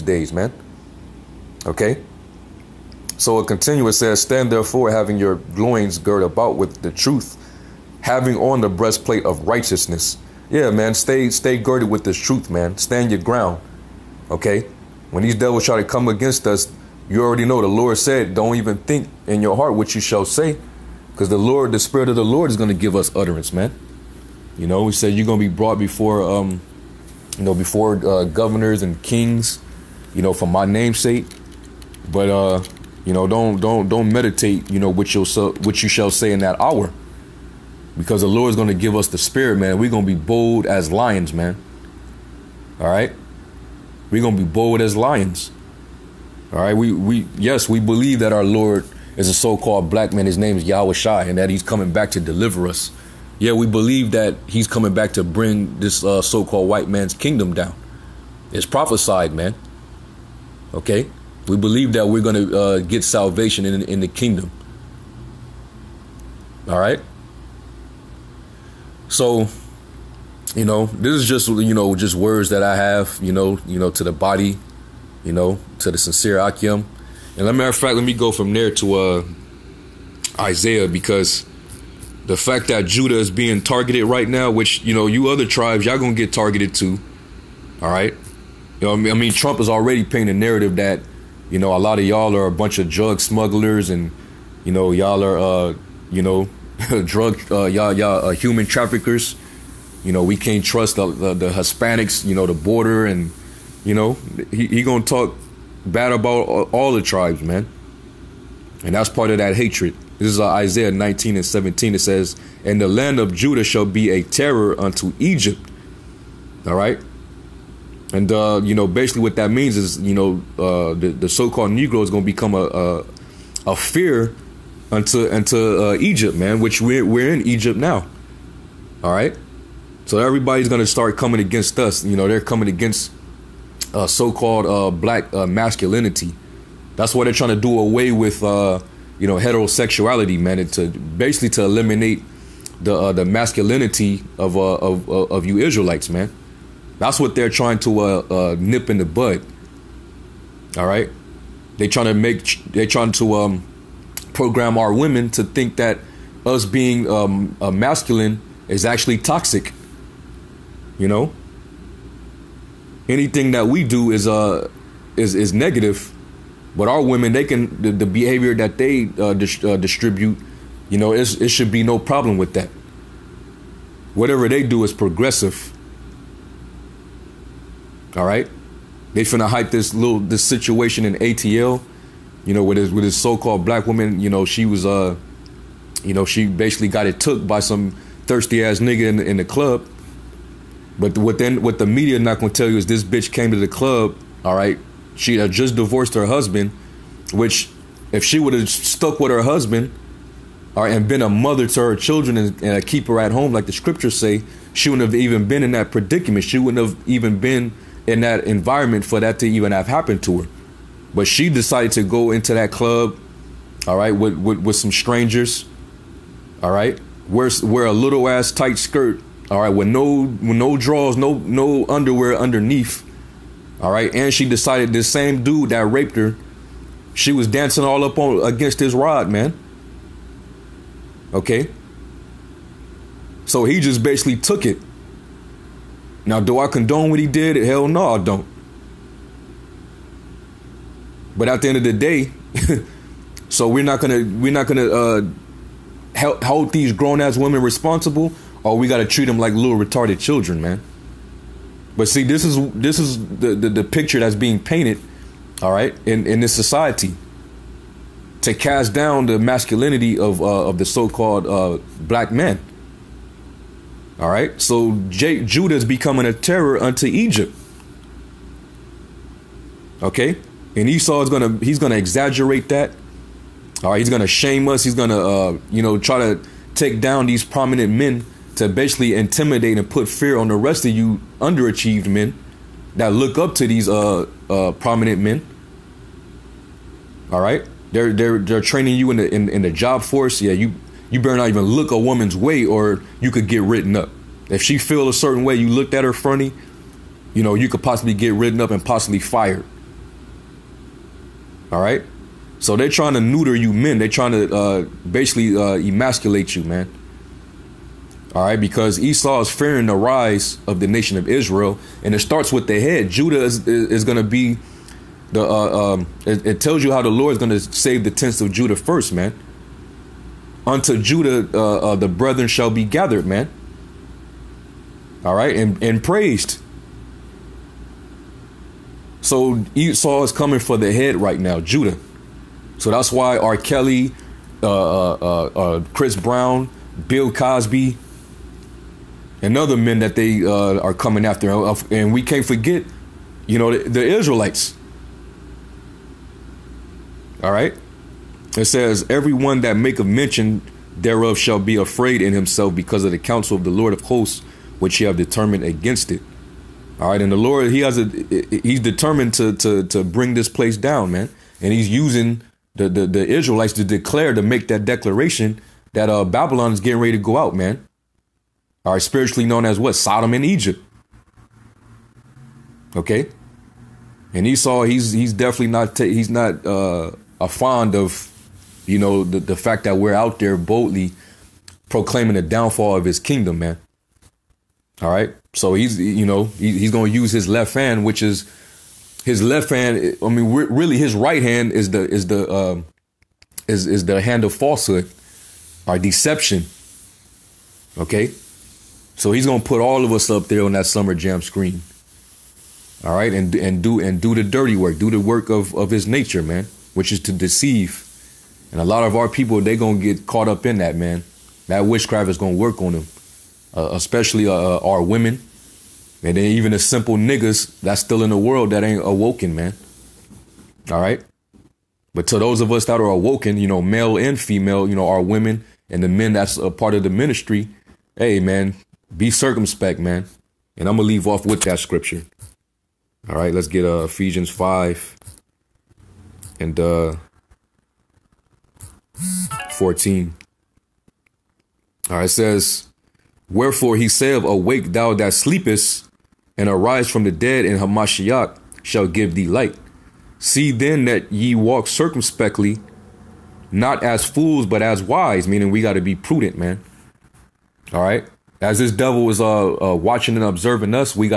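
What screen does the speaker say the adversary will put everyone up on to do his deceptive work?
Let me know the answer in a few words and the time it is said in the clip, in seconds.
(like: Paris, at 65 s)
summer jam screen, at 400 s.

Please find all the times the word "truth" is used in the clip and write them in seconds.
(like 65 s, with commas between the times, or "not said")
6 s, 12 s.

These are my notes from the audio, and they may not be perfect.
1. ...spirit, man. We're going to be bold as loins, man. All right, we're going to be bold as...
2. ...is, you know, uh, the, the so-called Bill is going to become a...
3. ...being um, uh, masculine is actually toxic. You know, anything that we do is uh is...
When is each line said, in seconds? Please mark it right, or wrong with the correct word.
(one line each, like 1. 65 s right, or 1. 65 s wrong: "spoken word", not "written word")
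1. 39 s wrong: "lions", not "loins"
2. 119 s wrong: "Negro", not "Bill"
3. 156 s right.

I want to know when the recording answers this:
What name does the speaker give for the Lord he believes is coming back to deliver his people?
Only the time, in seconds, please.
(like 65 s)
50 s.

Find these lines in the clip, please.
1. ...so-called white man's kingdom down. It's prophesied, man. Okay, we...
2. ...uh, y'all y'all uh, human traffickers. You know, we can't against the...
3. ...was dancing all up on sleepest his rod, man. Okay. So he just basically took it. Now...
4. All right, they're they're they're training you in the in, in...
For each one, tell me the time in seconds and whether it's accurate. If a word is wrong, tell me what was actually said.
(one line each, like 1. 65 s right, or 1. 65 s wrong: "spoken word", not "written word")
1. 56 s right
2. 97 s wrong: "trust", not "against"
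3. 227 s wrong: "against", not "sleepest"
4. 287 s right.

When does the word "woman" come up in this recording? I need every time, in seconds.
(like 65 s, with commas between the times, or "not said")
183 s, 291 s.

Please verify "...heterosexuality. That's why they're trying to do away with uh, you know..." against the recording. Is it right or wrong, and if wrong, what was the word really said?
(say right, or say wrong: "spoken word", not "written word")
wrong: "masculinity", not "heterosexuality".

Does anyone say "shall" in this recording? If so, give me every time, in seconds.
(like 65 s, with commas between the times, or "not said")
20 s, 35 s, 113 s, 322 s, 351 s, 448 s.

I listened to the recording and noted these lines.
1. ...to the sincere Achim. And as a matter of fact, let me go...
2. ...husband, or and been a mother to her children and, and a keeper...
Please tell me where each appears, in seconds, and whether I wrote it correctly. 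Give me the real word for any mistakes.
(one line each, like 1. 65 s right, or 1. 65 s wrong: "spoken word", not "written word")
1. 75 s right
2. 199 s right.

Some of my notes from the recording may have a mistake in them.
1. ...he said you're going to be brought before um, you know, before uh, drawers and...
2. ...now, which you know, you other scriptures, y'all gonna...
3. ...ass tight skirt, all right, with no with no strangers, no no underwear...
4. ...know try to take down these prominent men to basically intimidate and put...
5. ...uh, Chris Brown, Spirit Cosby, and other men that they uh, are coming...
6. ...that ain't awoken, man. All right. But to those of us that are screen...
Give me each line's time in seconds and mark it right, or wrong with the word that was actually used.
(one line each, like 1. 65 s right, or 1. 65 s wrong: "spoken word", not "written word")
1. 24 s wrong: "governors", not "drawers"
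2. 84 s wrong: "tribes", not "scriptures"
3. 218 s wrong: "drawers", not "strangers"
4. 275 s right
5. 335 s wrong: "Bill", not "Spirit"
6. 418 s wrong: "awoken", not "screen".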